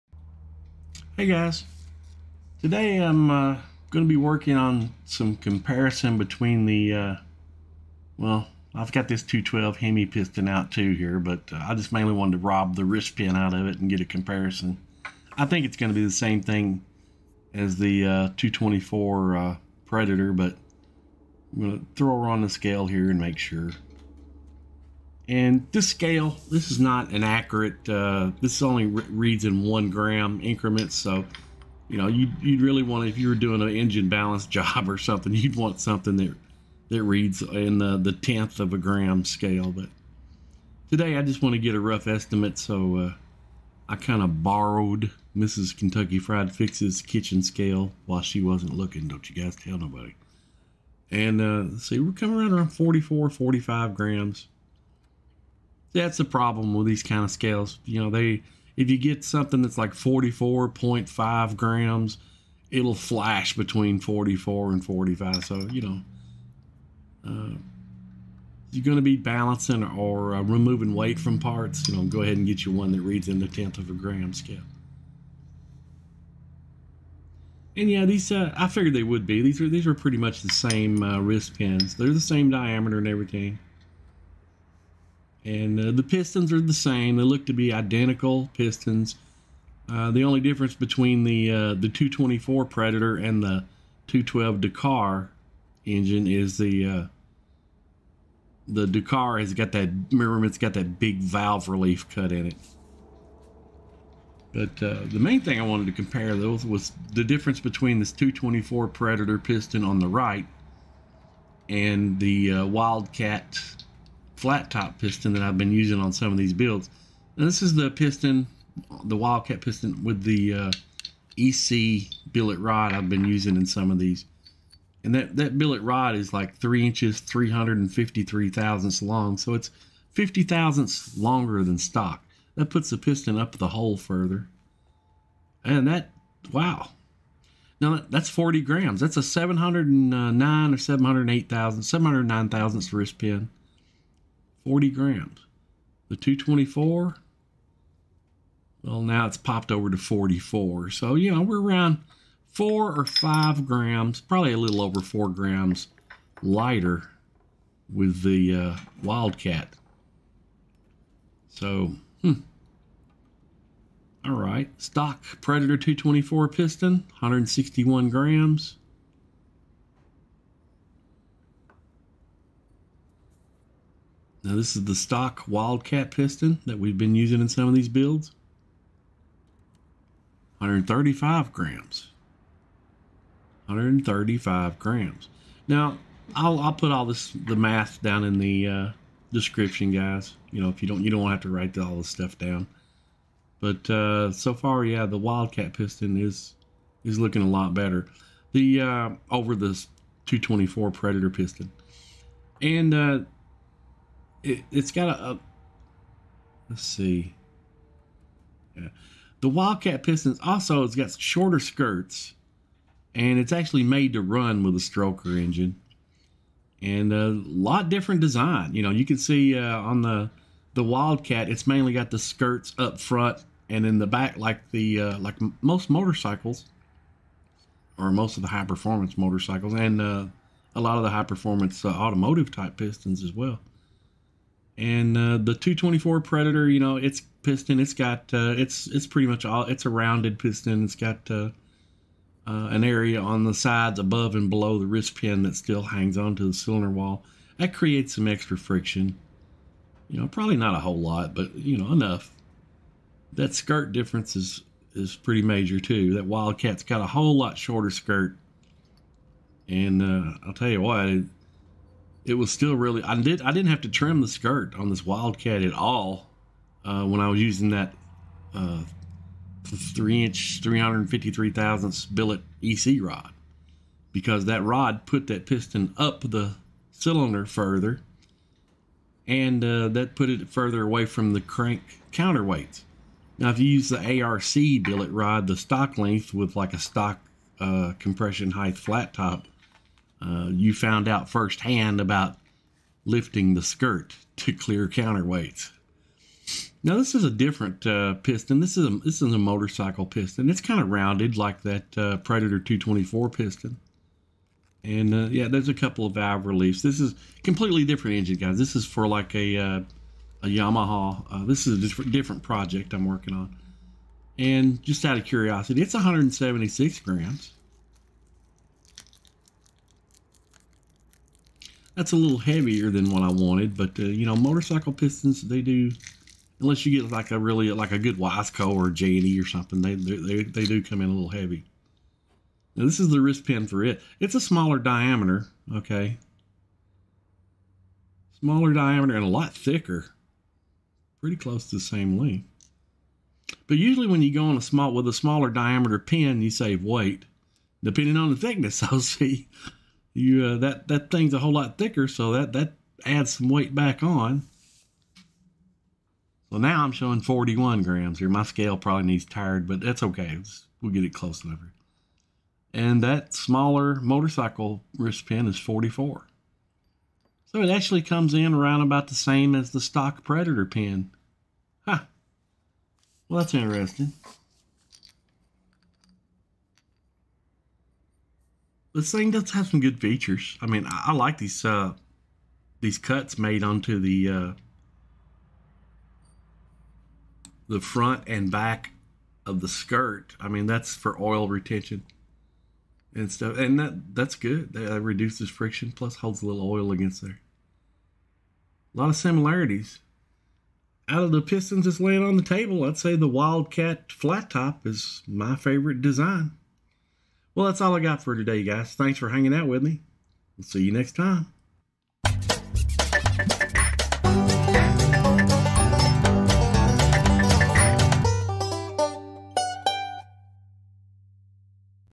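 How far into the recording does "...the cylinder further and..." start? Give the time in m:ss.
4:36.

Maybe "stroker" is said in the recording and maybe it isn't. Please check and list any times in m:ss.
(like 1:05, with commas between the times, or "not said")
3:34.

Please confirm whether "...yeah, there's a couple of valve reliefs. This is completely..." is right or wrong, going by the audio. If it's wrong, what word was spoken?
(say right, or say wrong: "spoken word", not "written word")
right.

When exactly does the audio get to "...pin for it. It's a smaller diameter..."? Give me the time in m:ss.
5:33.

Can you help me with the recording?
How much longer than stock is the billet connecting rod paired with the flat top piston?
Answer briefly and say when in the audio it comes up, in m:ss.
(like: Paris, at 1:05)
50 thousandths, at 2:10.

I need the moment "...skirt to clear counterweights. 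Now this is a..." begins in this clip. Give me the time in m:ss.
4:53.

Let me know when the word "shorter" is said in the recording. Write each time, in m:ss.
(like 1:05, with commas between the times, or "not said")
3:31, 4:17.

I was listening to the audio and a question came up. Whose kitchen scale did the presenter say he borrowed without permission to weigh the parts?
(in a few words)
Mrs. Kentucky Fried Fix.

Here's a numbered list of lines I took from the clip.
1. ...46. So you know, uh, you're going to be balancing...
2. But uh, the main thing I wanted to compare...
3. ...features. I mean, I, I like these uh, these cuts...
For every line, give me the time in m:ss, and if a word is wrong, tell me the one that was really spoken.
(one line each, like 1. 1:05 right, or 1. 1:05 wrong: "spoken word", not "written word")
1. 1:04 wrong: "45", not "46"
2. 1:44 right
3. 6:20 right.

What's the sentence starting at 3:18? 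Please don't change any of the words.
The uh, over this 224 Predator piston, and uh, it, has got a, a, let's see yeah.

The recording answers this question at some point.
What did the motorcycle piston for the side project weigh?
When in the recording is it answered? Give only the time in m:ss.
5:15.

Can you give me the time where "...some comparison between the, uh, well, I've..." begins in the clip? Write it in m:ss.
0:05.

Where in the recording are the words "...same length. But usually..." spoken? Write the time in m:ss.
5:41.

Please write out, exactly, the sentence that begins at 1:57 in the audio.
And this is the piston, the Wildcat piston with the uh, EC billet rod I've been using in some of these.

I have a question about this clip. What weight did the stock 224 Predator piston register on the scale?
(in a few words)
161 grams.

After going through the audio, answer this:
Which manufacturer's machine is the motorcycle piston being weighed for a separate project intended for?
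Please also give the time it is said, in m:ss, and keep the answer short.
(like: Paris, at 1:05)
Yamaha, at 5:10.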